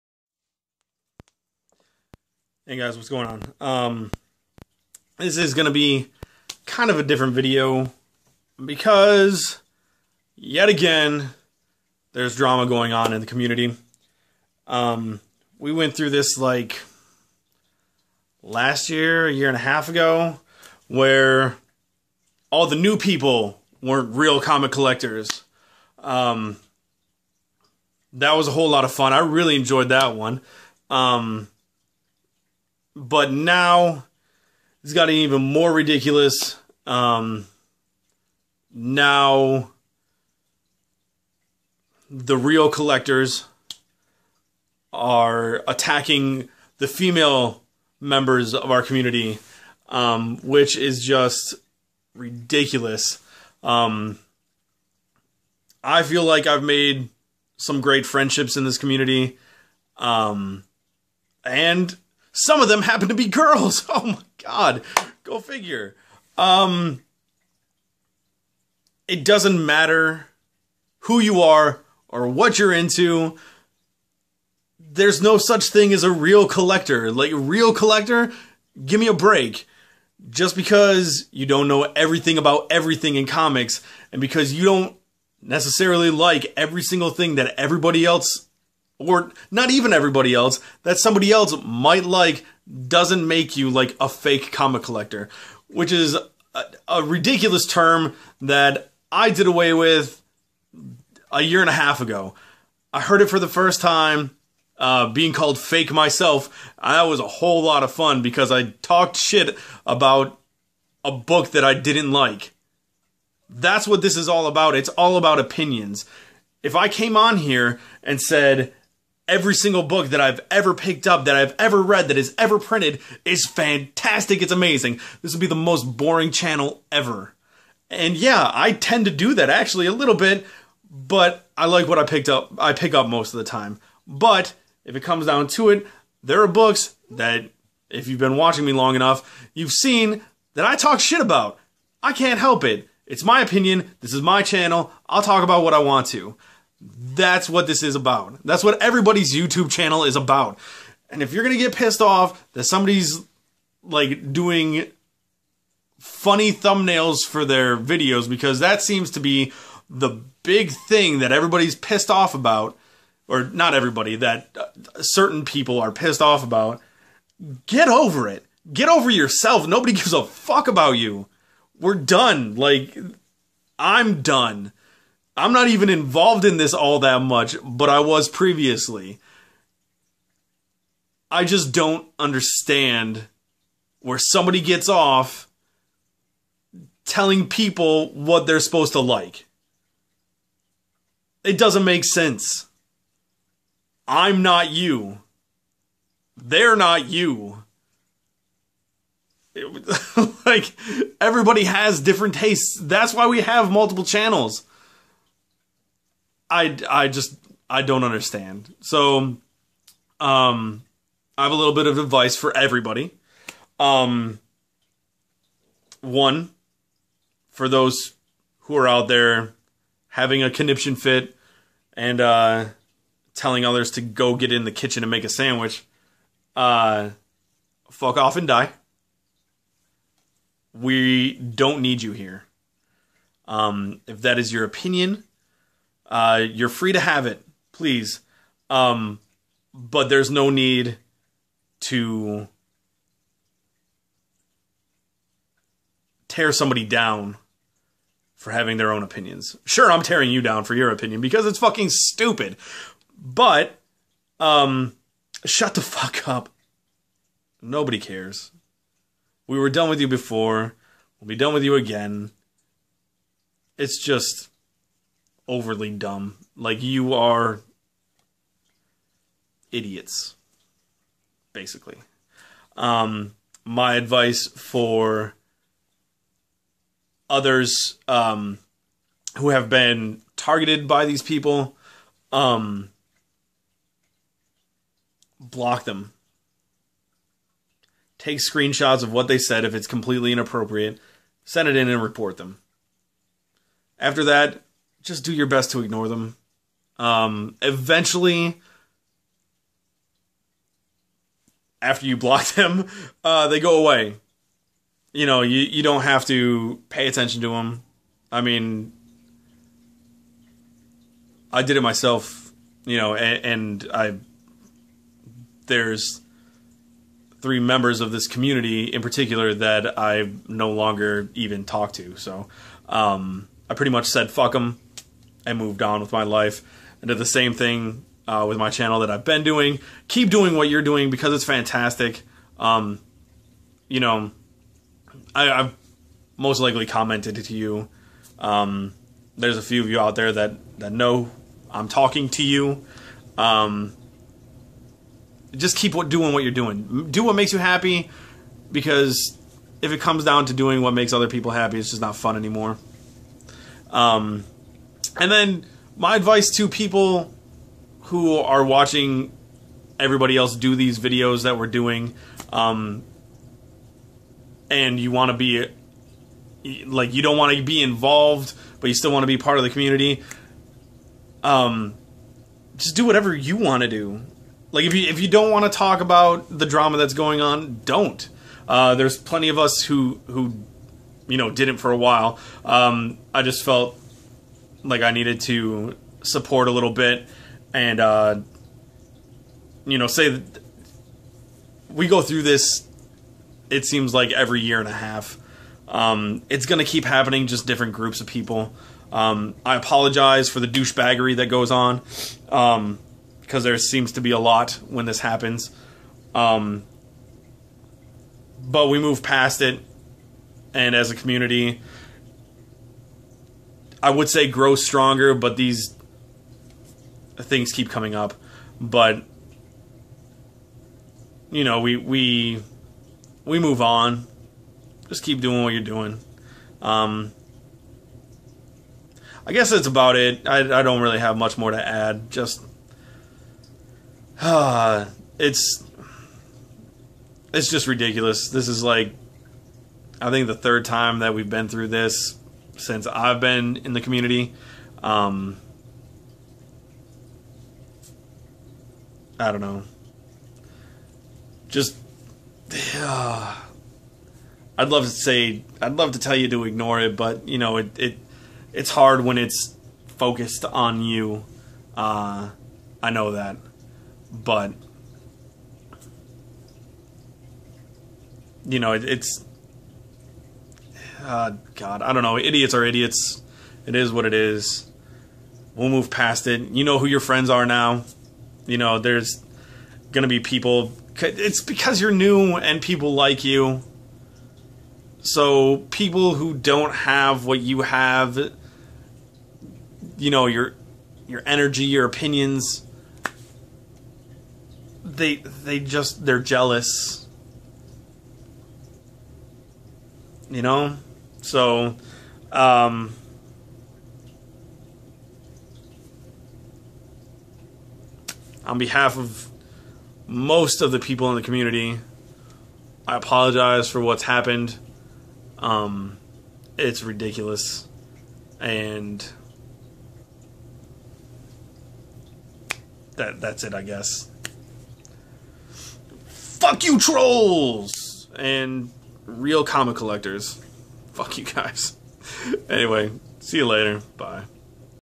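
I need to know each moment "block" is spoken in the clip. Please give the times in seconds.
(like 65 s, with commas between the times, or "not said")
285 s, 302 s.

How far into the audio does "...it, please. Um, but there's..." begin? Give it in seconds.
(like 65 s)
237 s.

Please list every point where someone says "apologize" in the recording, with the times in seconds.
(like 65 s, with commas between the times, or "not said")
399 s, 513 s.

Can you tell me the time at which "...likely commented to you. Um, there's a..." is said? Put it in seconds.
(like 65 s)
336 s.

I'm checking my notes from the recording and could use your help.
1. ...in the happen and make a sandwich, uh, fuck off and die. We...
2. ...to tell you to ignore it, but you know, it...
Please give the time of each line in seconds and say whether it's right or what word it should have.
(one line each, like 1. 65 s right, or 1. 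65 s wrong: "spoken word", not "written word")
1. 224 s wrong: "kitchen", not "happen"
2. 456 s right.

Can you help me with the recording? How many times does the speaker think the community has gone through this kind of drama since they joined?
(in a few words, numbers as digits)
3.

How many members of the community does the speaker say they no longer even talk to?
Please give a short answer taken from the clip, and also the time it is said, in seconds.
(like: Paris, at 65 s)
3, at 317 s.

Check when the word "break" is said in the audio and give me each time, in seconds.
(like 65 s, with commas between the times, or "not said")
79 s.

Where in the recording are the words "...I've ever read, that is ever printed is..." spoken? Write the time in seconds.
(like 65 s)
121 s.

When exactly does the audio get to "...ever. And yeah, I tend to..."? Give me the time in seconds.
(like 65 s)
126 s.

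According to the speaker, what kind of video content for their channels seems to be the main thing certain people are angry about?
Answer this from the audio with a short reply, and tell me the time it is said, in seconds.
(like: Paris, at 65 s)
funny thumbnails, at 155 s.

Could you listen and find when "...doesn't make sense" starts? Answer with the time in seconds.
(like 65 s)
191 s.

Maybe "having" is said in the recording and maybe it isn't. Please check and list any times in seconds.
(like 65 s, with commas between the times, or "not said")
220 s, 248 s.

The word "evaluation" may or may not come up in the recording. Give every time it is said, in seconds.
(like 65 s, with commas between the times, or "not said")
not said.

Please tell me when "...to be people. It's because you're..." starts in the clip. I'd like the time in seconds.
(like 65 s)
480 s.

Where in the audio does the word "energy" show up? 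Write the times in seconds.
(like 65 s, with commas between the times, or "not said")
491 s.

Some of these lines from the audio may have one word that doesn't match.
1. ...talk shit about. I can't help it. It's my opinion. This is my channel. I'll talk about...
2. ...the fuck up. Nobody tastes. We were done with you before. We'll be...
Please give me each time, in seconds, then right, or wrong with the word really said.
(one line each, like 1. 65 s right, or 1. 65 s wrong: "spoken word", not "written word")
1. 140 s right
2. 255 s wrong: "cares", not "tastes".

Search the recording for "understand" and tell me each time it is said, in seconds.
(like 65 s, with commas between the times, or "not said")
182 s, 208 s.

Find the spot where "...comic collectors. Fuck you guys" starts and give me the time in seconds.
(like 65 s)
529 s.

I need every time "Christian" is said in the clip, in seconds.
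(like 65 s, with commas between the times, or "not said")
not said.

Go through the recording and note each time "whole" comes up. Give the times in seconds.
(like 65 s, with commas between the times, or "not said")
28 s, 107 s.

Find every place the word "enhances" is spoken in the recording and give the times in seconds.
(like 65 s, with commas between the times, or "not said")
not said.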